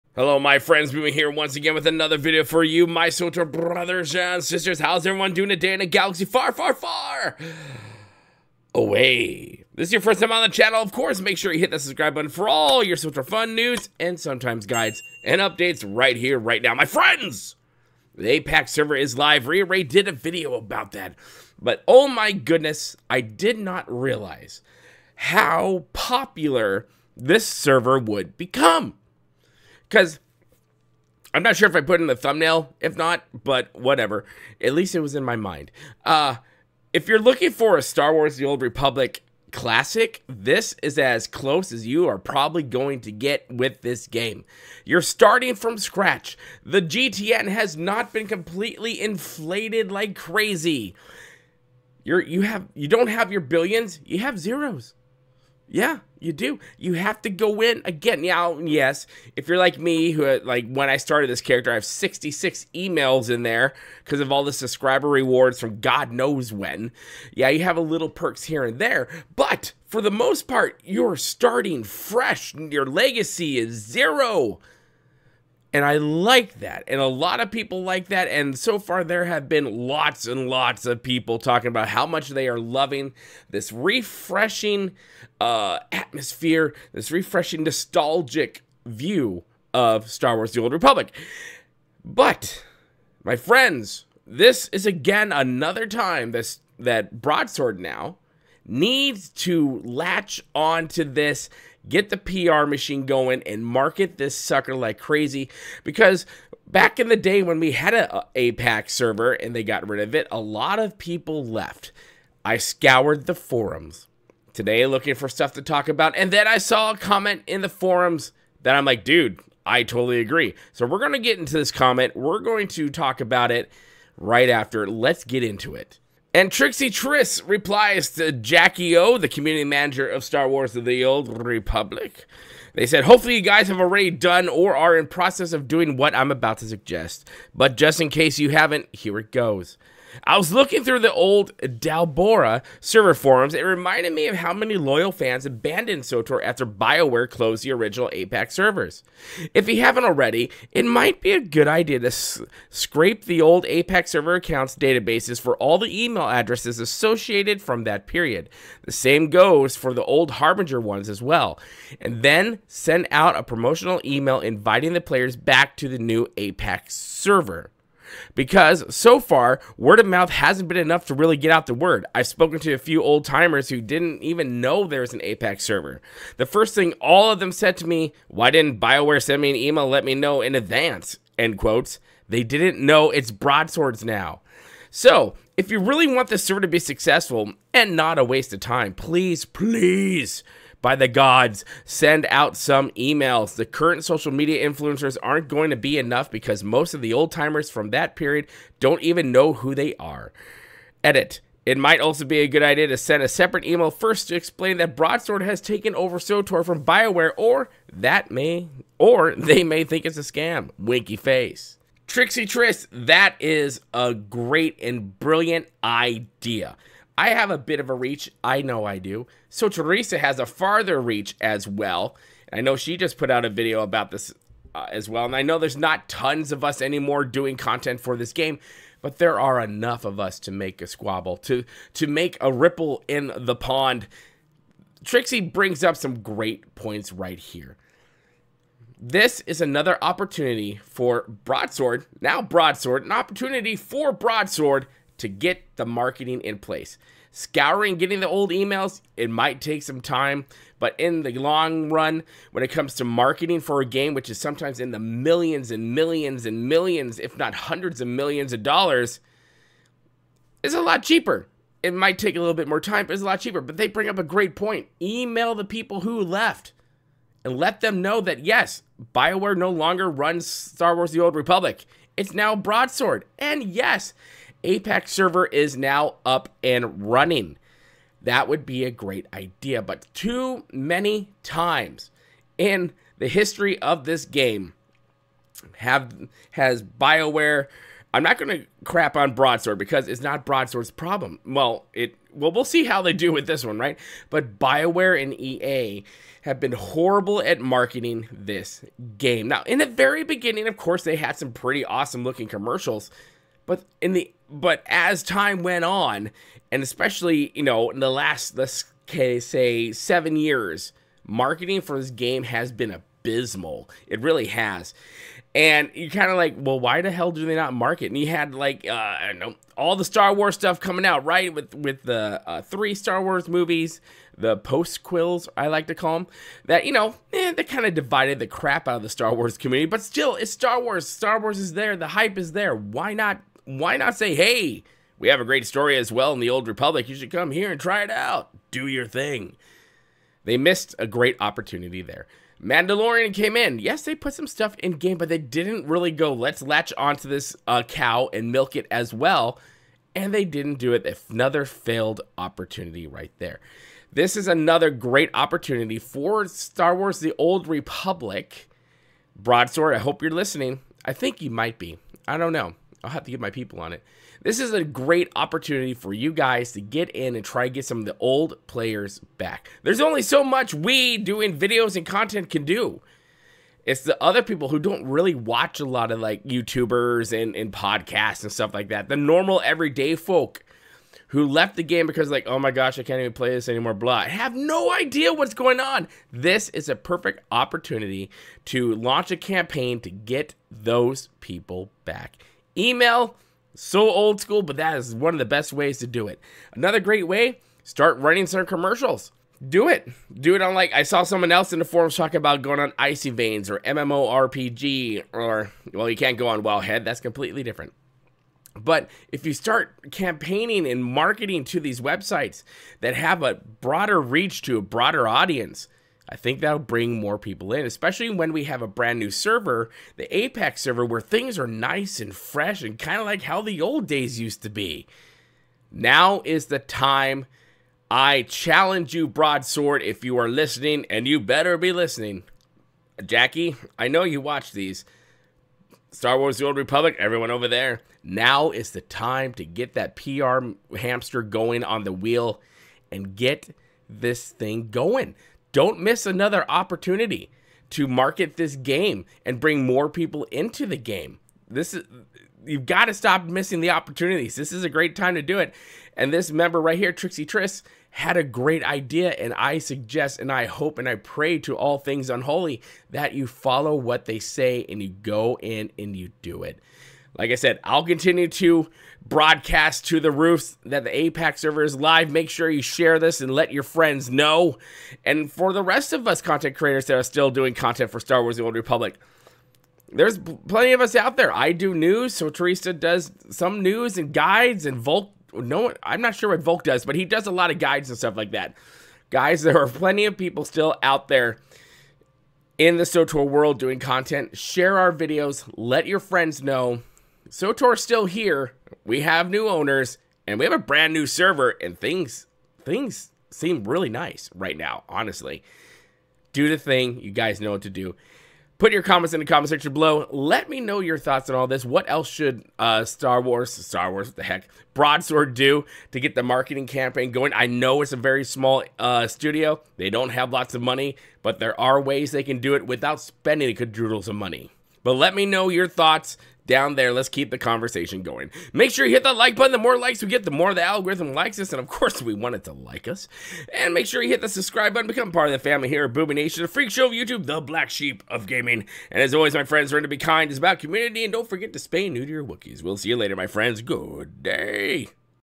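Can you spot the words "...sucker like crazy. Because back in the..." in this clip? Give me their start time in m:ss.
1:44.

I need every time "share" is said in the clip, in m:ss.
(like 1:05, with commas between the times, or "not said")
7:52, 8:14.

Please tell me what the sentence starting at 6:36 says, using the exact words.
Another great way, start running some commercials.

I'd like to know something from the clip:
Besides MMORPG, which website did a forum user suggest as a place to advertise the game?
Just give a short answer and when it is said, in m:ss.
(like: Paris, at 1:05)
Icy Veins, at 6:42.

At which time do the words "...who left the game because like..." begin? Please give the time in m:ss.
6:21.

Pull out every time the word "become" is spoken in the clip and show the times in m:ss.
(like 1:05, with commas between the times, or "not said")
0:28, 8:55.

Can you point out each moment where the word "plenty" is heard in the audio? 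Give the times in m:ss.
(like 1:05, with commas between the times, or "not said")
8:00, 8:09.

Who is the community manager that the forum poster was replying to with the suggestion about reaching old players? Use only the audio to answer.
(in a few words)
Jackie O.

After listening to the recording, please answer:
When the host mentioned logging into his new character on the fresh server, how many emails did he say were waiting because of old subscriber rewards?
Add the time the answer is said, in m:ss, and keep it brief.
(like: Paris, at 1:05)
66, at 1:01.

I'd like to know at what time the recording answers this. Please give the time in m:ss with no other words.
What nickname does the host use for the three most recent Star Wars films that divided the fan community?
5:24.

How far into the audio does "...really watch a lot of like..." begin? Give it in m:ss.
6:15.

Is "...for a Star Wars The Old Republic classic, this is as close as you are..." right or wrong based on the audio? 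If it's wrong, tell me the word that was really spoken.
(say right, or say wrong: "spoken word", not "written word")
right.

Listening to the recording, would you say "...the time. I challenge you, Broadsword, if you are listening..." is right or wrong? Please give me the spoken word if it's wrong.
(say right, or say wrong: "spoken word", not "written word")
right.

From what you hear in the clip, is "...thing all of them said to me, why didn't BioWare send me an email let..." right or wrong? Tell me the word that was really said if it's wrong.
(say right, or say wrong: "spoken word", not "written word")
right.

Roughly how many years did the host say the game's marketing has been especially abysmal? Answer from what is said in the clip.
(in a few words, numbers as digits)
7.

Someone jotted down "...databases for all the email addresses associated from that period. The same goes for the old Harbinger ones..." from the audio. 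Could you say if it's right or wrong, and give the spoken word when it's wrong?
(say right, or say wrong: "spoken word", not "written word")
right.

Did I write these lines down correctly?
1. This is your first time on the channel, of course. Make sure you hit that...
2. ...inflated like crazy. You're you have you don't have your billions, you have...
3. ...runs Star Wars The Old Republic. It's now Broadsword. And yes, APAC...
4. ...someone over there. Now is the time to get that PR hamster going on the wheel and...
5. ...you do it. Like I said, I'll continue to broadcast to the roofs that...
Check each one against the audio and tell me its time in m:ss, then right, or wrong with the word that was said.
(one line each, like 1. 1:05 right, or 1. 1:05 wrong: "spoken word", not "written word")
1. 0:09 right
2. 0:49 right
3. 4:30 right
4. 7:17 wrong: "everyone", not "someone"
5. 7:46 right.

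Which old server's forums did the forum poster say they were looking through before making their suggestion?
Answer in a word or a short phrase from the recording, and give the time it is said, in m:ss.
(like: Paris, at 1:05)
Dalborra, at 2:21.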